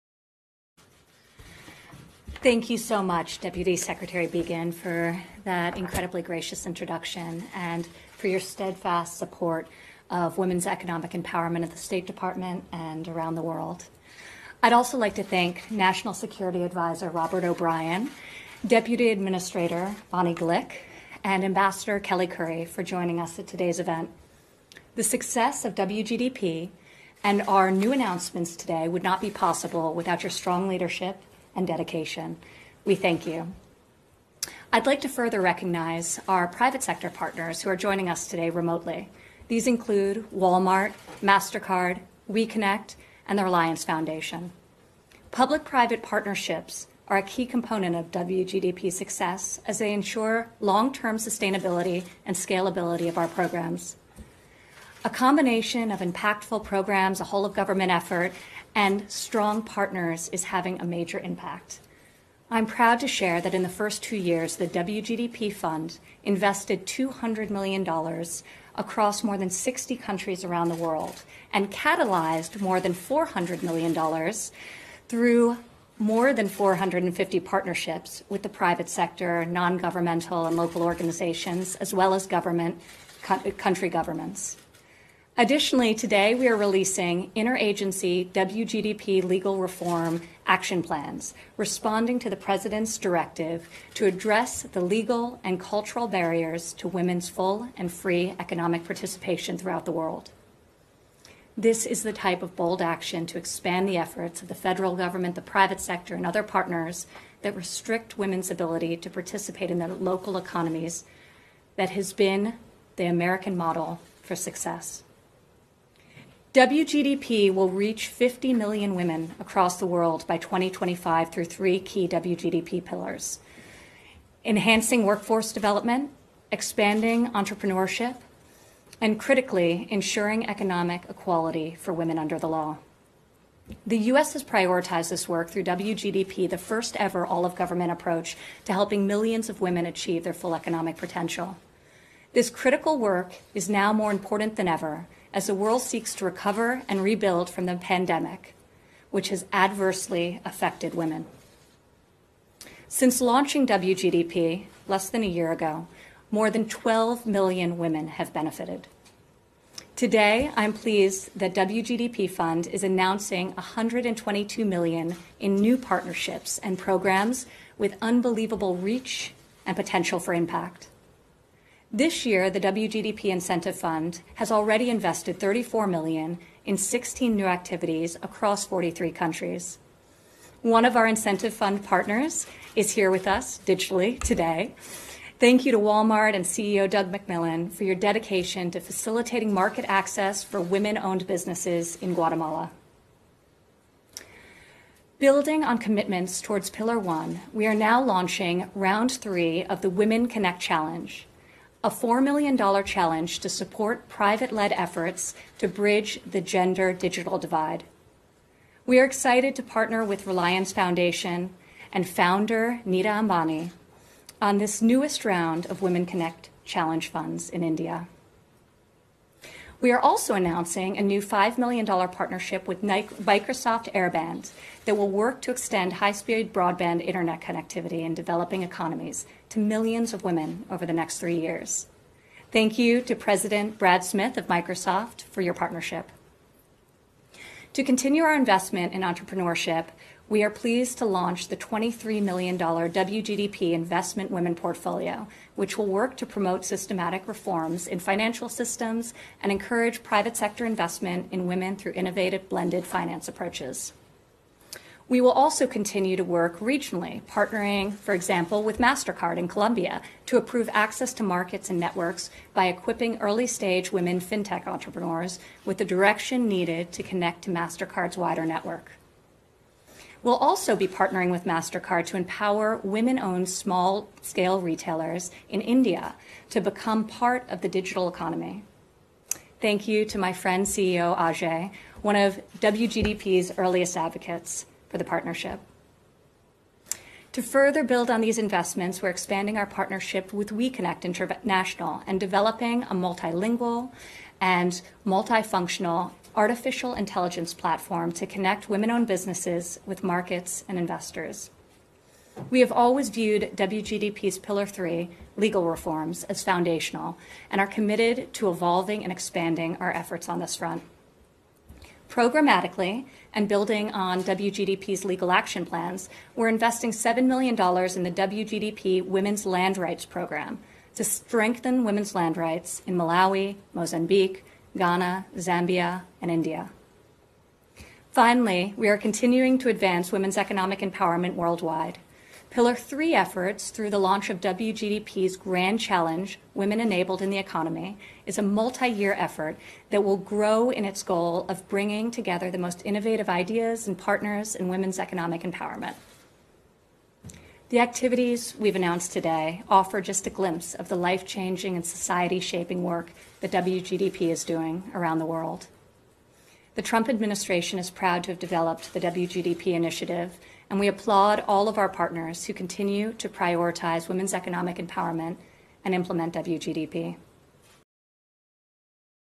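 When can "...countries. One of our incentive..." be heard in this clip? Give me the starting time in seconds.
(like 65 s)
179 s.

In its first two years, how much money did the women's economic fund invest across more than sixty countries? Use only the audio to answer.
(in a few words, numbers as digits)
$200 million.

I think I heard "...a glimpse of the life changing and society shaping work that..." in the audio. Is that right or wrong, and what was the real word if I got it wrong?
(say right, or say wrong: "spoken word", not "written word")
right.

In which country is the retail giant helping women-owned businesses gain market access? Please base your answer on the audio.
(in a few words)
Guatemala.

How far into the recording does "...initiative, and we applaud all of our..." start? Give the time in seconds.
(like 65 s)
359 s.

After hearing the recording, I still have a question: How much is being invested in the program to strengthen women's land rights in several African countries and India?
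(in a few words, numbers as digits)
$7 million.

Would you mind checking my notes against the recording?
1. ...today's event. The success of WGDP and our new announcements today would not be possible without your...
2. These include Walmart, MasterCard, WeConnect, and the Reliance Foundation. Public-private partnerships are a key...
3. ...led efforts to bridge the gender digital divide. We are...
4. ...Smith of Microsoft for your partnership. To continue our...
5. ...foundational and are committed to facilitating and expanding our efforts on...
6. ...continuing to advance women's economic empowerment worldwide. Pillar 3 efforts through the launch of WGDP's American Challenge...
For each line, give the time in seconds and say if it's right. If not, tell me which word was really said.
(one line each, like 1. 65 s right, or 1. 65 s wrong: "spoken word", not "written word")
1. 23 s right
2. 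39 s right
3. 204 s right
4. 234 s right
5. 306 s wrong: "evolving", not "facilitating"
6. 328 s wrong: "Grand", not "American".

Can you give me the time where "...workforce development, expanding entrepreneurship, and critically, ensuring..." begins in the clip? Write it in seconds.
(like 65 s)
125 s.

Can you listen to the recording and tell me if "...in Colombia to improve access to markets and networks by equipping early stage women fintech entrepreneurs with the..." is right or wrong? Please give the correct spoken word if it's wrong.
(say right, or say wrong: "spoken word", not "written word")
right.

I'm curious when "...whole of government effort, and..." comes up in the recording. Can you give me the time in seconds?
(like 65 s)
57 s.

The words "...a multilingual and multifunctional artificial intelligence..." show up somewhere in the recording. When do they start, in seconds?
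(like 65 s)
292 s.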